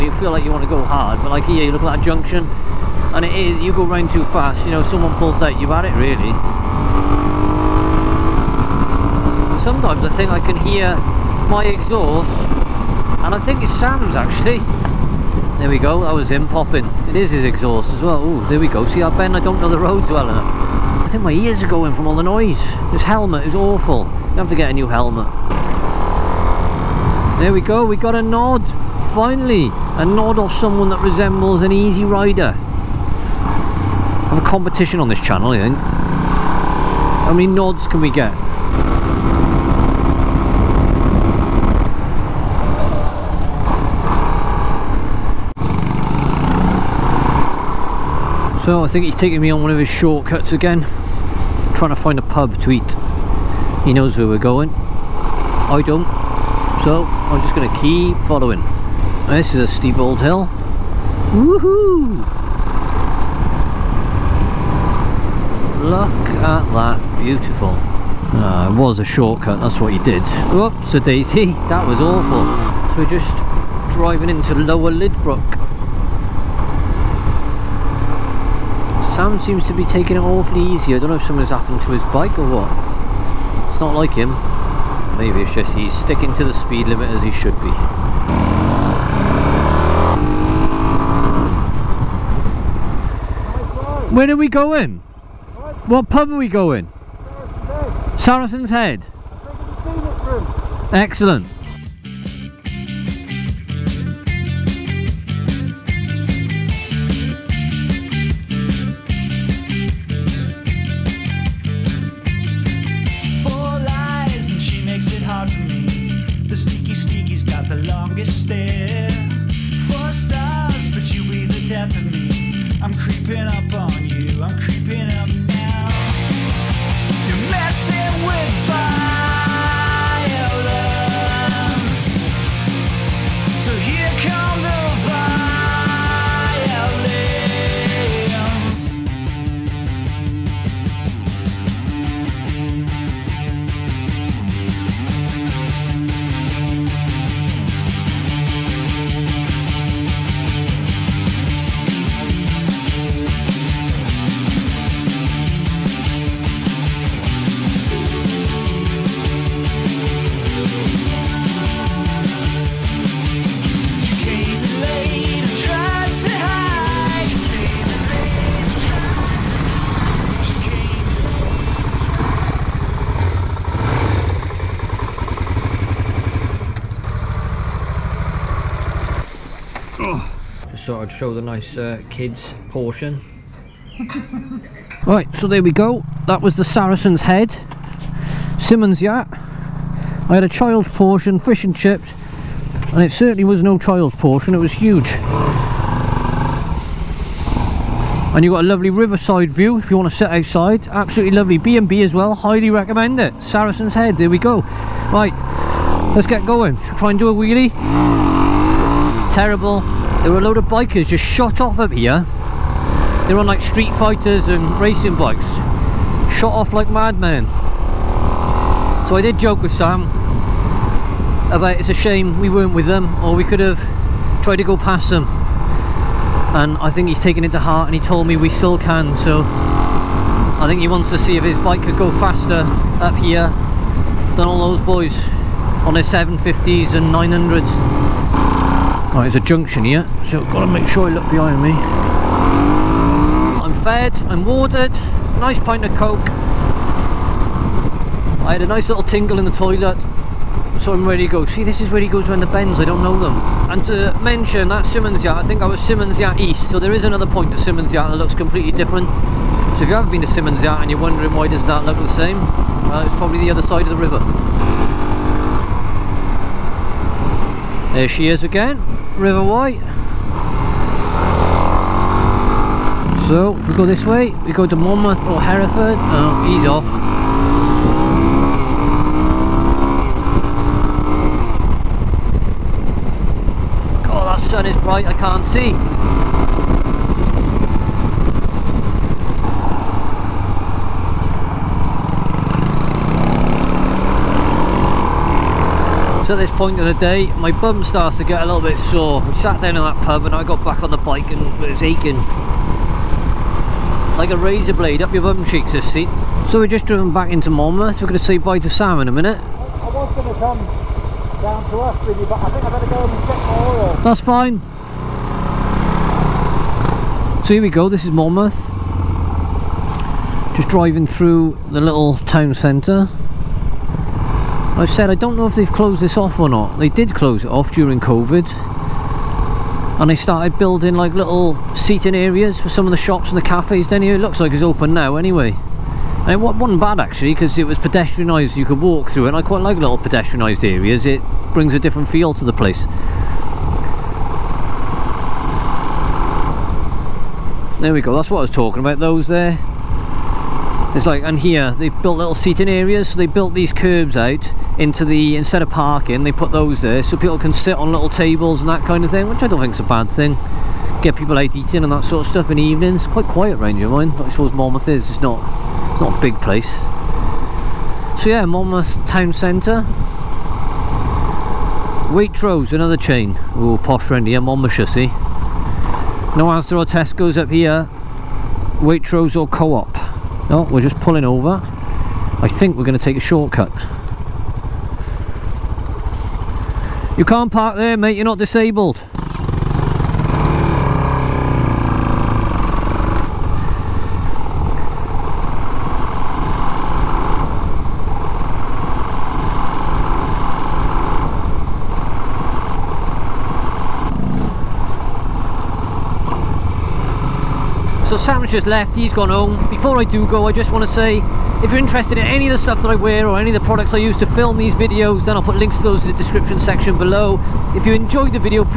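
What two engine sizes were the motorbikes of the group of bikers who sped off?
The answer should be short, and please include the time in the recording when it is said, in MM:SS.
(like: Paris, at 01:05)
750s and 900s, at 03:56.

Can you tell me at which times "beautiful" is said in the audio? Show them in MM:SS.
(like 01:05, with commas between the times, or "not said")
01:07.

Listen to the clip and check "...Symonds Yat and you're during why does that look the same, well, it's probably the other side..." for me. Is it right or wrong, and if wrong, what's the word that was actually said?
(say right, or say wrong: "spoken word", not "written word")
wrong: "wondering", not "during".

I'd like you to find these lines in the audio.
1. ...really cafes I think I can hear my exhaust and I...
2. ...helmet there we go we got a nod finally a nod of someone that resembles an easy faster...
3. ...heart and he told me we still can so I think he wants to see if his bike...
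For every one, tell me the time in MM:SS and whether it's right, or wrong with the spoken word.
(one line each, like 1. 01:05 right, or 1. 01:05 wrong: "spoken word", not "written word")
1. 00:05 wrong: "sometimes", not "cafes"
2. 00:24 wrong: "rider", not "faster"
3. 03:47 right.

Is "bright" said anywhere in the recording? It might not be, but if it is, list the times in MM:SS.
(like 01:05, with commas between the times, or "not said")
04:44.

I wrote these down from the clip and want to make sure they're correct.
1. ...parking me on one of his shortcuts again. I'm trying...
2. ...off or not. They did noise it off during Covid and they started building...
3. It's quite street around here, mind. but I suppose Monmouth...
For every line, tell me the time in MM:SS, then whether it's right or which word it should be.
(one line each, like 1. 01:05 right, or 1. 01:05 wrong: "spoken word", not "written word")
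1. 00:49 wrong: "taking", not "parking"
2. 05:26 wrong: "close", not "noise"
3. 06:03 wrong: "quiet", not "street".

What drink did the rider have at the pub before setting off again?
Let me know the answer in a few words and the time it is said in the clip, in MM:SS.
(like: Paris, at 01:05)
coke, at 04:05.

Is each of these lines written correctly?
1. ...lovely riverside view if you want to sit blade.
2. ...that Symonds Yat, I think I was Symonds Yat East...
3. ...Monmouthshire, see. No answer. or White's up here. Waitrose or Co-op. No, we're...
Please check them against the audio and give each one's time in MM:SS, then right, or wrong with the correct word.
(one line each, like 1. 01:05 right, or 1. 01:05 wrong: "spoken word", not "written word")
1. 03:18 wrong: "outside", not "blade"
2. 04:14 right
3. 06:14 wrong: "Tesco", not "White".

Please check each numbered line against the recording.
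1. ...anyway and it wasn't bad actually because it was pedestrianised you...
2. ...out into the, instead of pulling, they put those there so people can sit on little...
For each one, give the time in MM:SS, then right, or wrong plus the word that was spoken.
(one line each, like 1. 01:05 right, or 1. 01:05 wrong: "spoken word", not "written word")
1. 05:35 right
2. 05:54 wrong: "parking", not "pulling".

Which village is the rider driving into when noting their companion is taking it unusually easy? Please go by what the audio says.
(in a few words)
Lower Lydbrook.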